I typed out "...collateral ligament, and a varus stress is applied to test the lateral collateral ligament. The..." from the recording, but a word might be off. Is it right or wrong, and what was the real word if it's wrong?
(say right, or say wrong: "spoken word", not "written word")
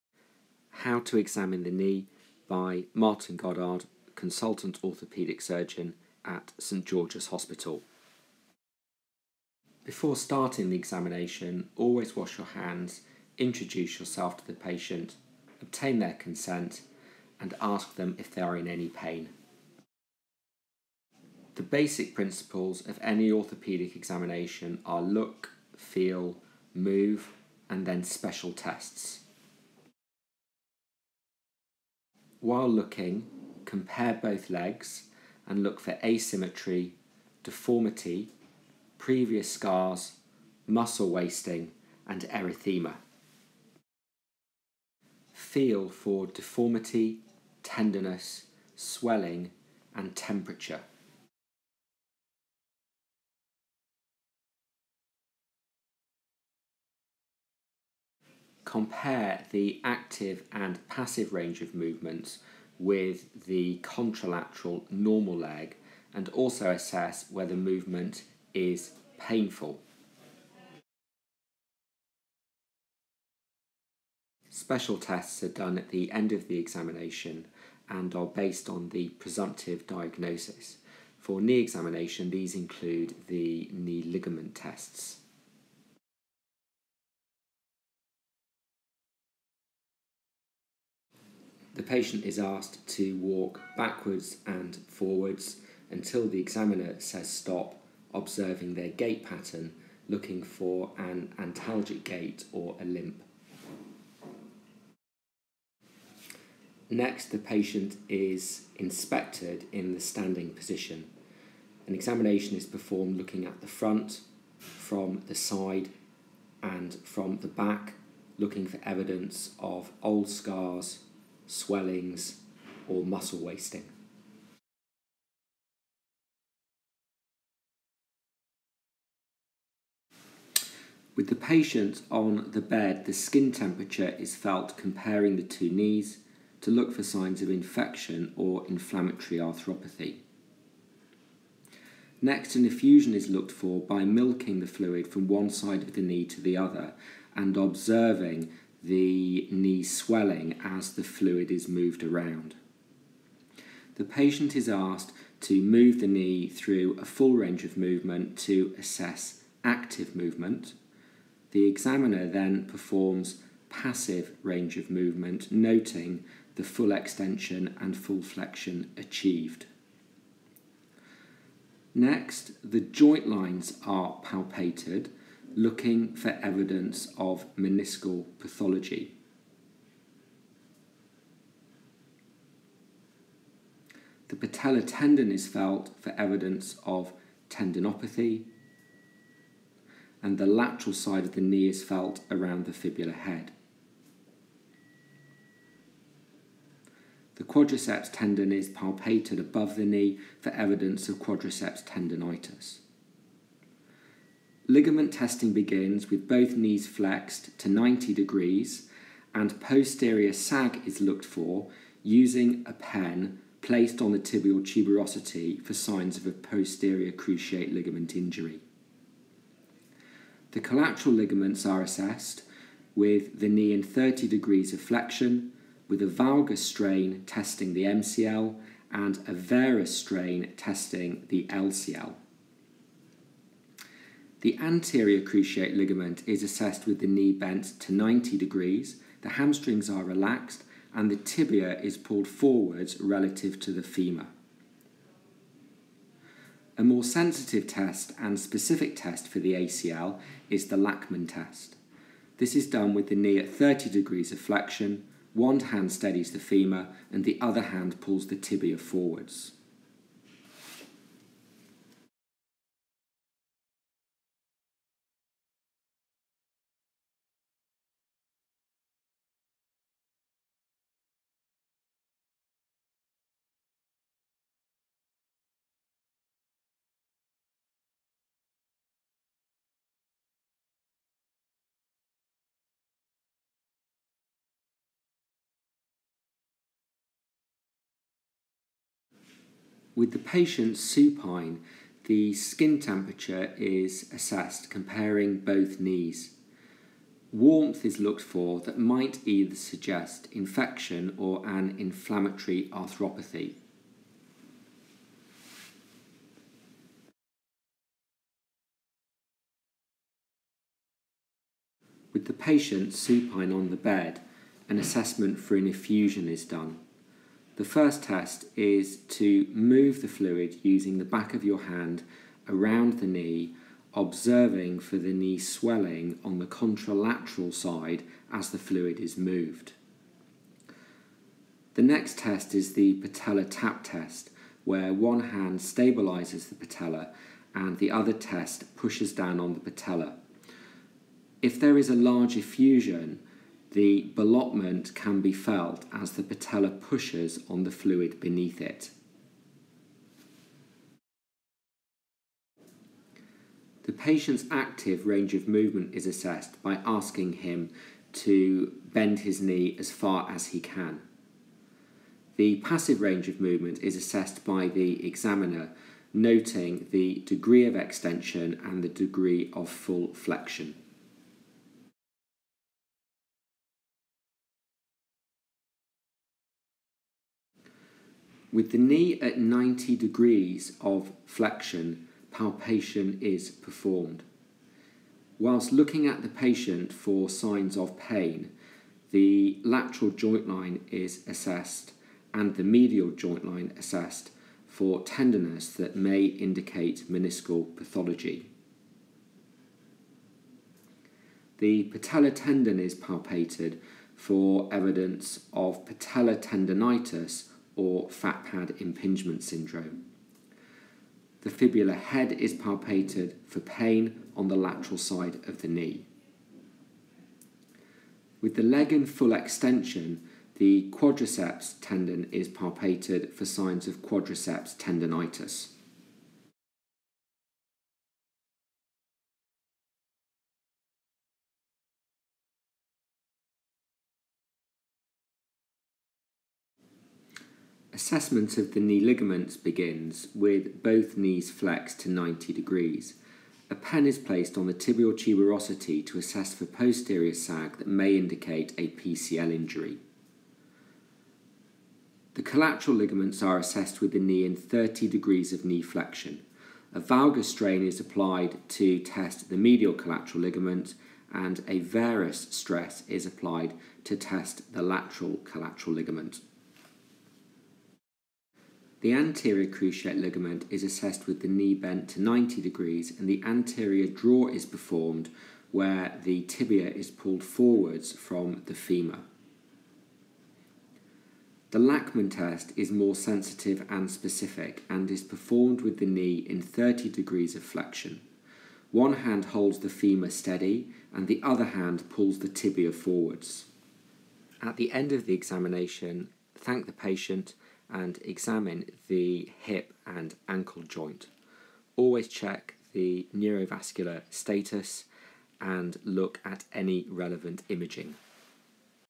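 right.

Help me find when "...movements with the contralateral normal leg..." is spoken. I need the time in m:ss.
1:01.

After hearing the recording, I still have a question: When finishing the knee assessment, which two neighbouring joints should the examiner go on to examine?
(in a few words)
hip and ankle.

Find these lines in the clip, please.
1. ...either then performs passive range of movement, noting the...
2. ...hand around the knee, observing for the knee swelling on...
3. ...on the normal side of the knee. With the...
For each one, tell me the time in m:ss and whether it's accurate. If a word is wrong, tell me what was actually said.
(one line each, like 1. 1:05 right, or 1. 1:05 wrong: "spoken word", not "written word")
1. 2:41 wrong: "examiner", not "either"
2. 5:21 right
3. 6:54 wrong: "lateral", not "normal".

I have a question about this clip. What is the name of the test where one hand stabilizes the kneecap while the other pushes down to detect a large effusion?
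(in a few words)
patella tap test.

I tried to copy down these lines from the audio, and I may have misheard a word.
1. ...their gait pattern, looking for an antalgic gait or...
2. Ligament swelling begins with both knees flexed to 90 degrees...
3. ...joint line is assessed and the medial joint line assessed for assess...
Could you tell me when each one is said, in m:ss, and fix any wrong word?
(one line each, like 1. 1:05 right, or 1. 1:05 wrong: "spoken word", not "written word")
1. 1:38 right
2. 3:24 wrong: "testing", not "swelling"
3. 6:30 wrong: "tenderness", not "assess".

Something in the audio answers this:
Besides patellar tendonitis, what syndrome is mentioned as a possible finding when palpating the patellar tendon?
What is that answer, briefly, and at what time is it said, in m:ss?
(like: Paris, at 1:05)
fat pad impingement syndrome, at 6:48.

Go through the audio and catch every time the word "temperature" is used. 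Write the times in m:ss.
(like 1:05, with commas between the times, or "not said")
0:50, 2:13, 4:52.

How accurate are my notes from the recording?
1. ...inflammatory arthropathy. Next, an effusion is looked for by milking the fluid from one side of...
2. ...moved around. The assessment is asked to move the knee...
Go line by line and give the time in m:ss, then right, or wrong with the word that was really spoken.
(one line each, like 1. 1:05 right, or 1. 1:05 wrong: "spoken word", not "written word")
1. 2:18 right
2. 2:31 wrong: "patient", not "assessment".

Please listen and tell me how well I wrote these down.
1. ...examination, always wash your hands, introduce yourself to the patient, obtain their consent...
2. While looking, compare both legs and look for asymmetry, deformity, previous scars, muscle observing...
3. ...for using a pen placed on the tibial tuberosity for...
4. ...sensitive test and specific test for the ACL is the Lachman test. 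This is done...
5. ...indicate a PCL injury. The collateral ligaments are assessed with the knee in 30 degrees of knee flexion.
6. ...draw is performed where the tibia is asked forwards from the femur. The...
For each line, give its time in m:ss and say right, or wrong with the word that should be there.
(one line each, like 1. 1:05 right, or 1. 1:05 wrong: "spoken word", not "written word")
1. 0:10 right
2. 0:32 wrong: "wasting", not "observing"
3. 3:31 right
4. 4:07 right
5. 7:28 right
6. 7:54 wrong: "pulled", not "asked".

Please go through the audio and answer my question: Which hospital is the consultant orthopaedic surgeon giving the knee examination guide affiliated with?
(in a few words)
St George's Hospital.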